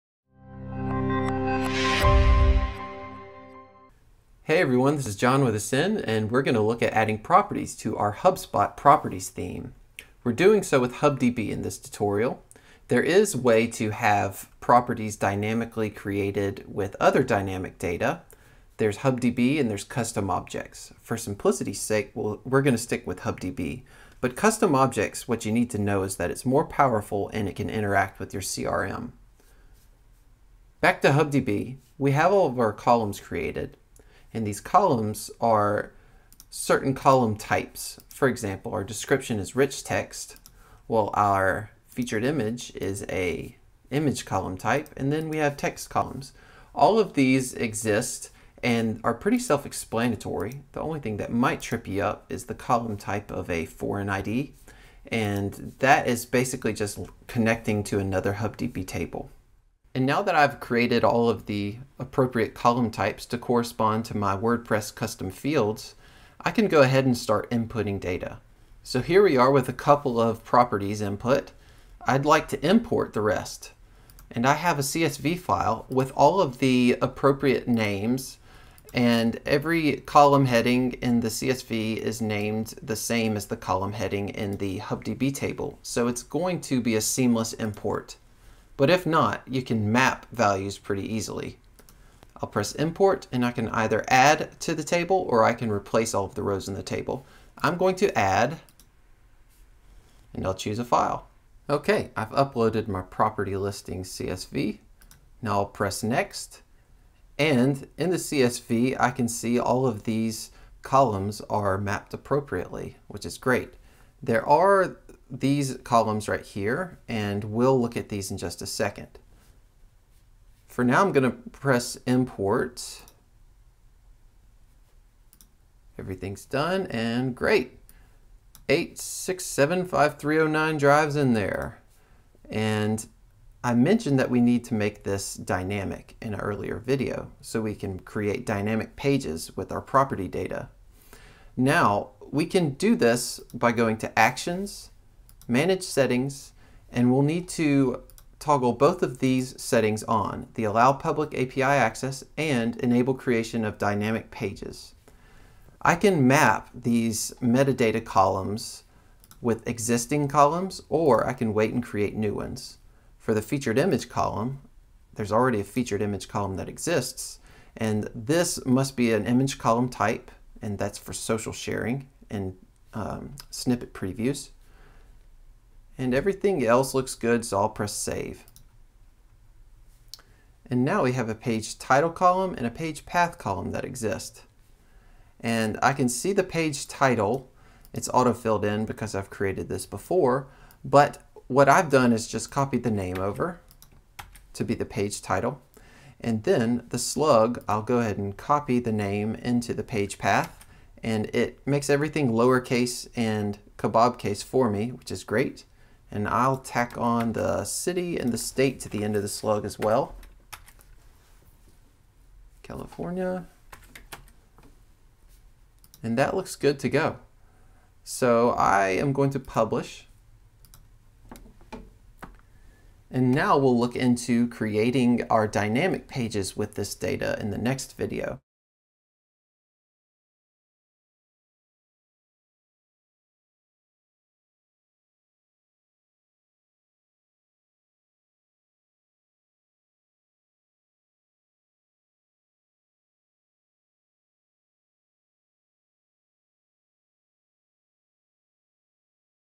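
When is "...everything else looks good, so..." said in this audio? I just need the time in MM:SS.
02:56.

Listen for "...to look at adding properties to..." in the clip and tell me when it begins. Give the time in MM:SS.
00:06.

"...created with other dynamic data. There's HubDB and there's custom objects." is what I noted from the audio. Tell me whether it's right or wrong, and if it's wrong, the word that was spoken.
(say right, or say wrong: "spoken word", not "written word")
right.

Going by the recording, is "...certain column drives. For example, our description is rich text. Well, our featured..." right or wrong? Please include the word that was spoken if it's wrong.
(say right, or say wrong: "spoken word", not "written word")
wrong: "types", not "drives".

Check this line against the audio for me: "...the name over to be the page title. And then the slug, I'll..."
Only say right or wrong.
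right.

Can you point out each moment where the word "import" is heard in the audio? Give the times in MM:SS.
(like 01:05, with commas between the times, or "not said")
01:12, 01:27, 01:32, 02:02.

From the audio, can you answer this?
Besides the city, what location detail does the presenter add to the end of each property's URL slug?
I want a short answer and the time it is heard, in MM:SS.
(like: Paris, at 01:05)
State, at 03:28.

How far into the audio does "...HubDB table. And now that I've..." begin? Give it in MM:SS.
00:58.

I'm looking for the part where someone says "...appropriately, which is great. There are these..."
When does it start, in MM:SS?
01:52.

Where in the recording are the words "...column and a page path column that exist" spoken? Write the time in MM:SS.
03:02.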